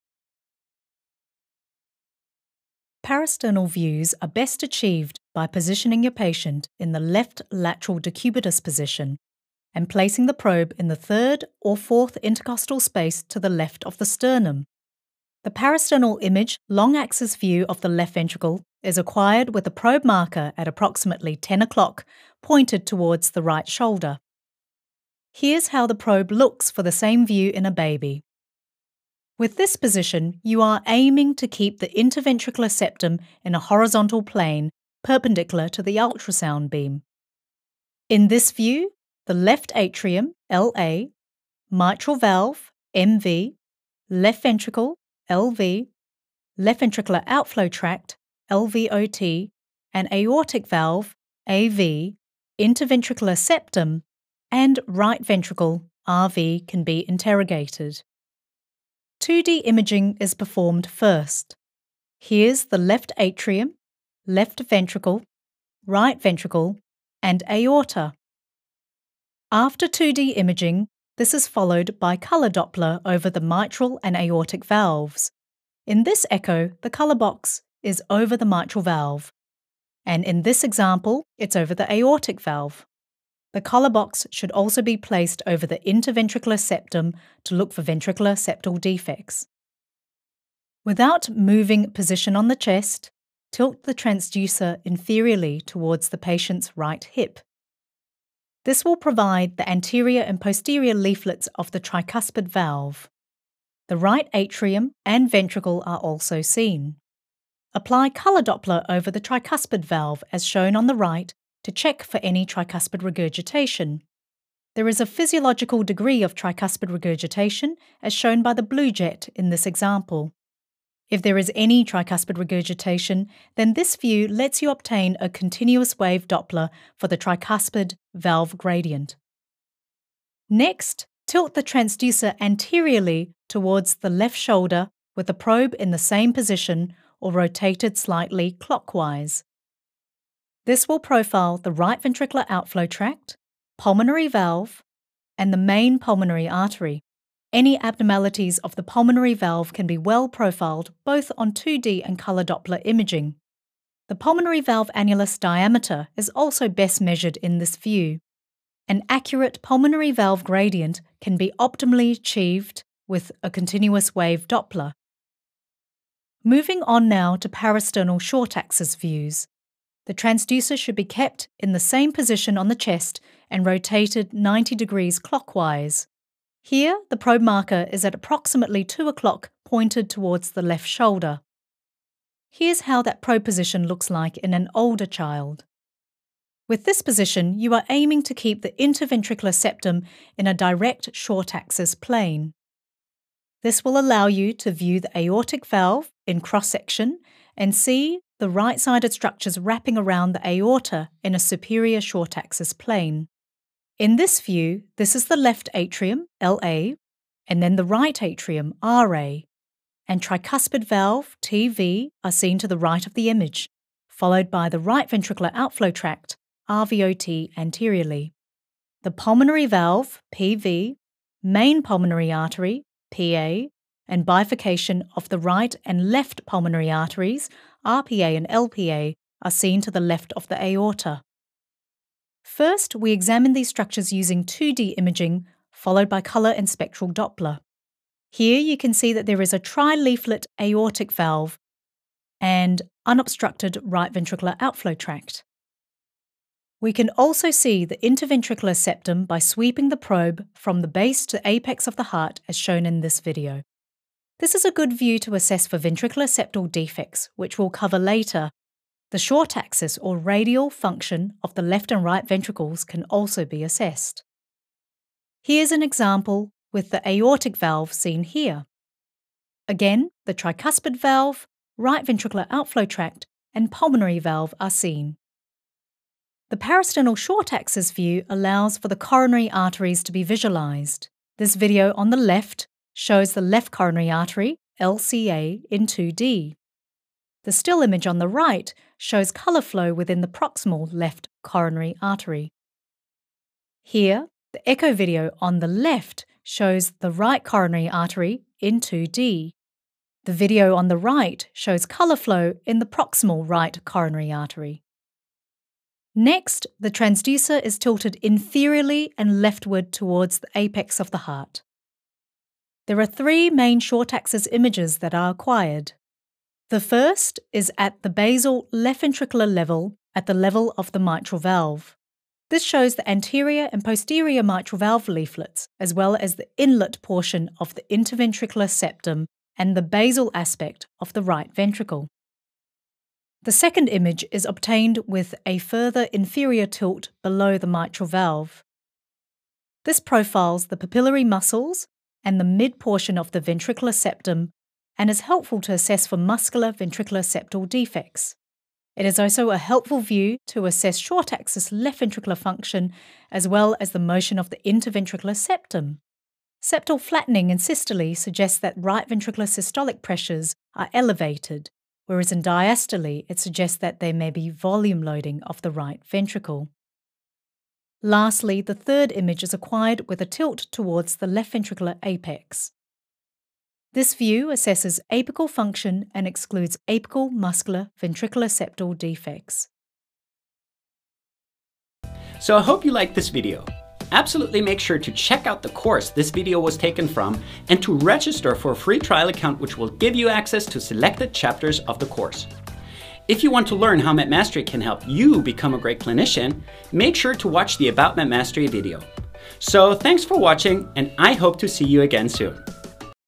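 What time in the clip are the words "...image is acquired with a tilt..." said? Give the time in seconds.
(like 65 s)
369 s.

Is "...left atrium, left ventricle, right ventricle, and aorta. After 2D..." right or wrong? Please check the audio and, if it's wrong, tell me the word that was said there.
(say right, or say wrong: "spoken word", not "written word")
right.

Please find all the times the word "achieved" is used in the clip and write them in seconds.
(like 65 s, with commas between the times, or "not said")
4 s, 162 s.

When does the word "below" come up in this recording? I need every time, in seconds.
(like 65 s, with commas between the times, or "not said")
337 s.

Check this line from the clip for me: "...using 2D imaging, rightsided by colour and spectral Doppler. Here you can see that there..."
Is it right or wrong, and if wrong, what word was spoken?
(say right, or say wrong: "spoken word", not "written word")
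wrong: "followed", not "rightsided".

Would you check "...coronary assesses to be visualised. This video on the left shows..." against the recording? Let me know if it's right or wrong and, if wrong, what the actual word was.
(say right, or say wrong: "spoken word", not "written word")
wrong: "arteries", not "assesses".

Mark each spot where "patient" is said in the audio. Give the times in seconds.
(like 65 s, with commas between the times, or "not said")
6 s, 96 s.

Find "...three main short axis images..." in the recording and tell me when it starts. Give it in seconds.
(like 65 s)
313 s.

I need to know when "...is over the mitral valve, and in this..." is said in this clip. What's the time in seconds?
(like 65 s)
77 s.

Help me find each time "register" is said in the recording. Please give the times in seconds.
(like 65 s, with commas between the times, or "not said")
387 s.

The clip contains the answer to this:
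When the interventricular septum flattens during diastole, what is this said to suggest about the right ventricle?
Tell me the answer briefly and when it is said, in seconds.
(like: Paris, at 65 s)
Volume loading, at 364 s.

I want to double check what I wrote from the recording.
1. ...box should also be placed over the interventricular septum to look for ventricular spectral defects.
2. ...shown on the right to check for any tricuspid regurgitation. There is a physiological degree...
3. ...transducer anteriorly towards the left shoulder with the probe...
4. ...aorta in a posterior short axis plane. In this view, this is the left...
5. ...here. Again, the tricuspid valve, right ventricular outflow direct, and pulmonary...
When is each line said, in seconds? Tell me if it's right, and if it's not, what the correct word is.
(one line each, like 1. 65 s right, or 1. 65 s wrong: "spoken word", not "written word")
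1. 83 s wrong: "septal", not "spectral"
2. 110 s right
3. 131 s right
4. 200 s wrong: "superior", not "posterior"
5. 268 s wrong: "tract", not "direct".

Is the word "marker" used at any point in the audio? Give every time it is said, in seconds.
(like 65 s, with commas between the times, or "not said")
20 s, 177 s.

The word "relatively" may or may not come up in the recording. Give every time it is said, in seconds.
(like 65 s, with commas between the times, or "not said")
not said.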